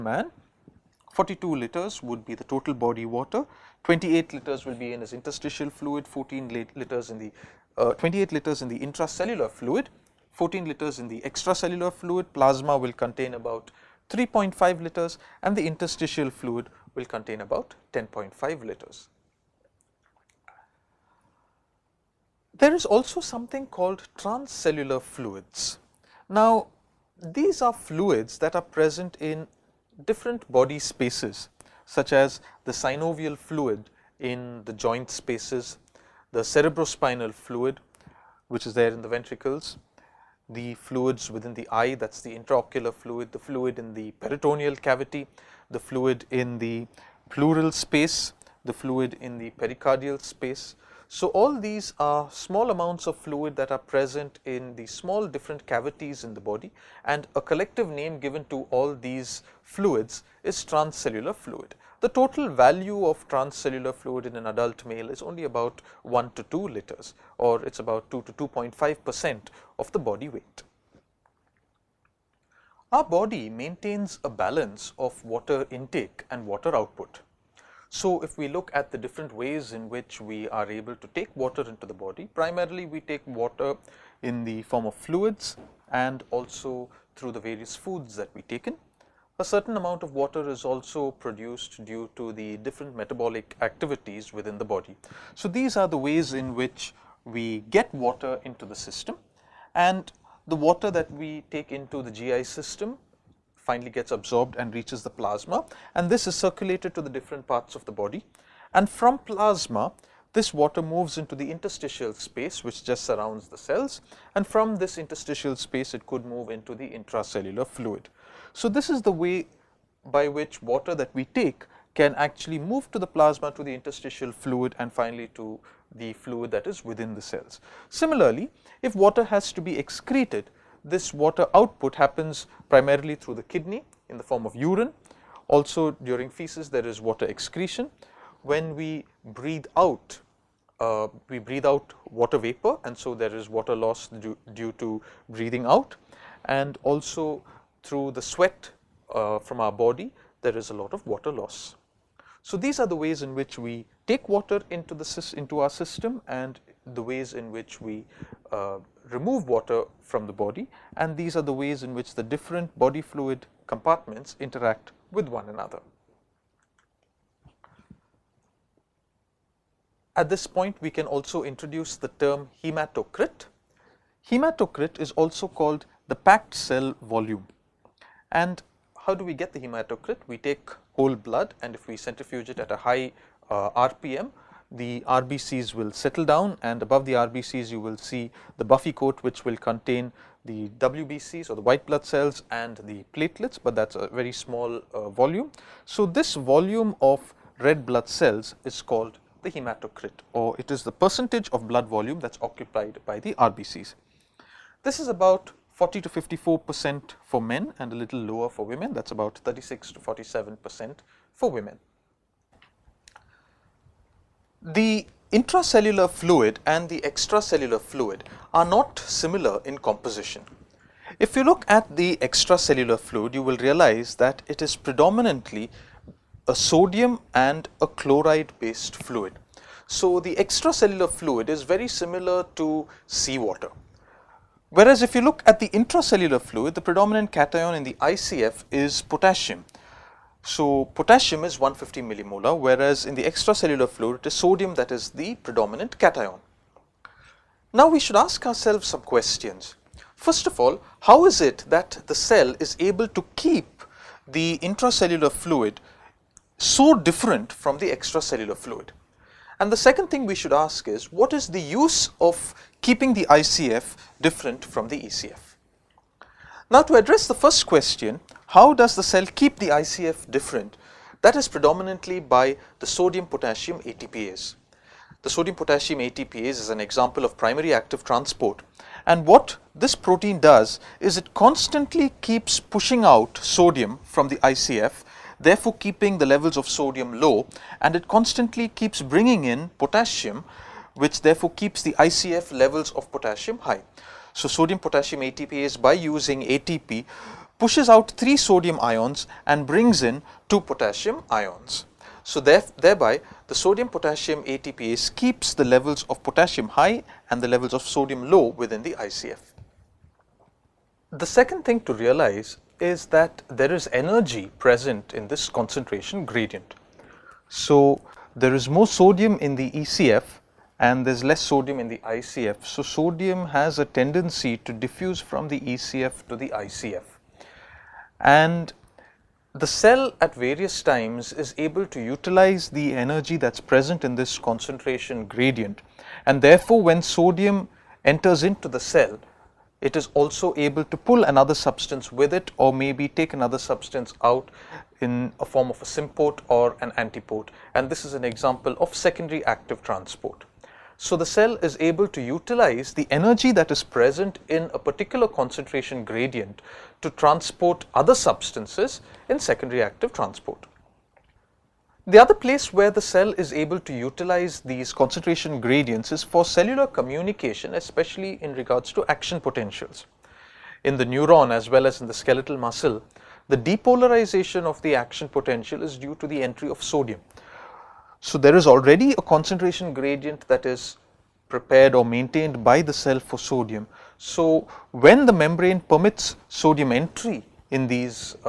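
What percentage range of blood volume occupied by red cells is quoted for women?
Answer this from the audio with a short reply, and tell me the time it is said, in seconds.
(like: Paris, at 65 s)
36 to 47 percent, at 209 s.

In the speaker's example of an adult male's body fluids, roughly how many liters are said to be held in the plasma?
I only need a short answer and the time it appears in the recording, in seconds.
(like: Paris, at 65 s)
3.5 liters, at 14 s.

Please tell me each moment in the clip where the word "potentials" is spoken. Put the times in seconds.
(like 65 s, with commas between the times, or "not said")
369 s, 375 s.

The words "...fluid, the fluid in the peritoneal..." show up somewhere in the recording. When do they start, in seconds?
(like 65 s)
42 s.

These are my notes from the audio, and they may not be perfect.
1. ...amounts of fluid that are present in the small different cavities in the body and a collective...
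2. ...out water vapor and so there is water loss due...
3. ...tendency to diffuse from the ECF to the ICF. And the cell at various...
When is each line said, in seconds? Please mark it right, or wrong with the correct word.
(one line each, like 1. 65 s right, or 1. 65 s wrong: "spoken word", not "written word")
1. 52 s right
2. 141 s right
3. 323 s right.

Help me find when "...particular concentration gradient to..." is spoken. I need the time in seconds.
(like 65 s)
354 s.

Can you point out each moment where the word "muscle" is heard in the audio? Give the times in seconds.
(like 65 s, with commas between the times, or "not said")
372 s.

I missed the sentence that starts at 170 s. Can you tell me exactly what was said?
At this point we can also introduce the term hematocrit.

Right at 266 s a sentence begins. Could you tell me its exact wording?
Now, to address the first question, how does the cell keep the ICF different?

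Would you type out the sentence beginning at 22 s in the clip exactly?
There is also something called transcellular fluids.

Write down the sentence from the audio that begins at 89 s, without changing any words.
A certain amount of water is also produced due to the different metabolic activities within the body.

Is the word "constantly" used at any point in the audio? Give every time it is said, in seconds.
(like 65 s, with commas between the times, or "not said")
281 s, 288 s.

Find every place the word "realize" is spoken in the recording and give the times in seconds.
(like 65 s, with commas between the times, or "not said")
223 s, 311 s.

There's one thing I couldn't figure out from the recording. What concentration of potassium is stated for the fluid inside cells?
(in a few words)
150 millimolar.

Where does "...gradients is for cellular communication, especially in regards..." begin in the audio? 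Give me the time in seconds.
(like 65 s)
365 s.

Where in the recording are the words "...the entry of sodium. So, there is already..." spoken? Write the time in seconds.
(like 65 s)
376 s.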